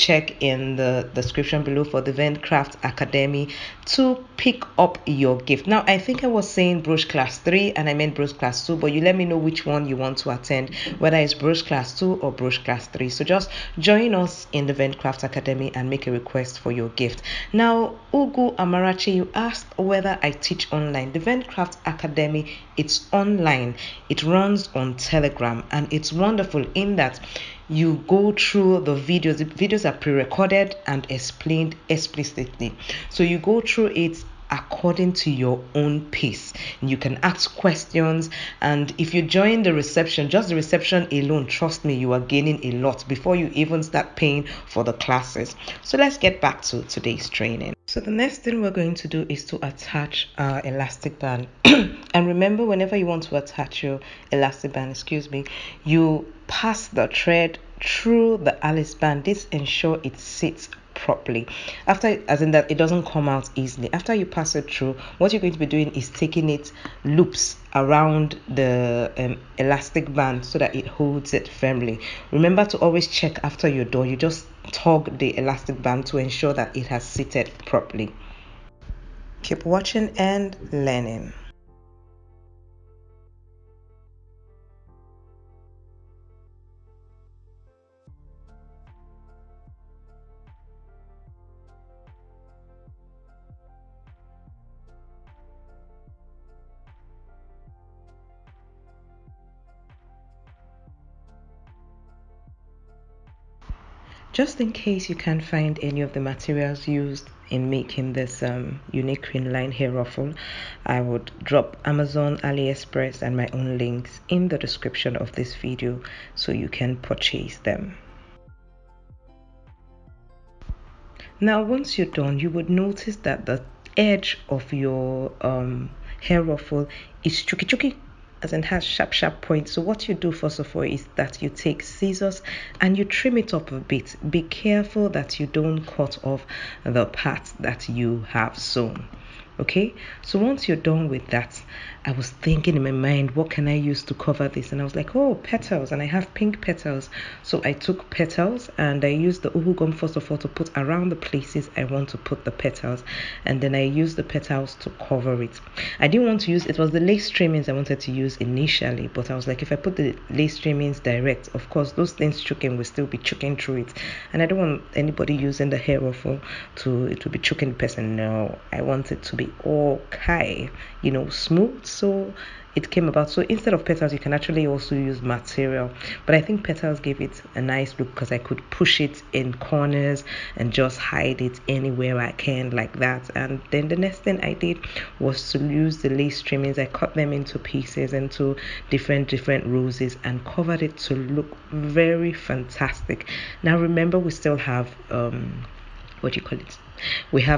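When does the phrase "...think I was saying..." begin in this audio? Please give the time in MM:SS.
00:05.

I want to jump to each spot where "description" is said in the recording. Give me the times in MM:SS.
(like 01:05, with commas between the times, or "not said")
00:01, 01:54.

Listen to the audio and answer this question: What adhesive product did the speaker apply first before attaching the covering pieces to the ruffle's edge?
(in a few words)
UHU gum.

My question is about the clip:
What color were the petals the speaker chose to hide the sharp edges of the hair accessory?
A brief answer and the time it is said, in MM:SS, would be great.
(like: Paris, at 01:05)
Pink, at 02:26.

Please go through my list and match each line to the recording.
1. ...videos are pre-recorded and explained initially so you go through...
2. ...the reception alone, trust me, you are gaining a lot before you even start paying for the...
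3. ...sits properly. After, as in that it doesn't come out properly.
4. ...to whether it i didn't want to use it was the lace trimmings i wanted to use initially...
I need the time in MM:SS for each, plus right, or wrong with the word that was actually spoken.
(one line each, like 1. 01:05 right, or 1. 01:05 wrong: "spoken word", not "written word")
1. 00:29 wrong: "explicitly", not "initially"
2. 00:40 right
3. 01:00 wrong: "easily", not "properly"
4. 02:34 wrong: "cover", not "whether".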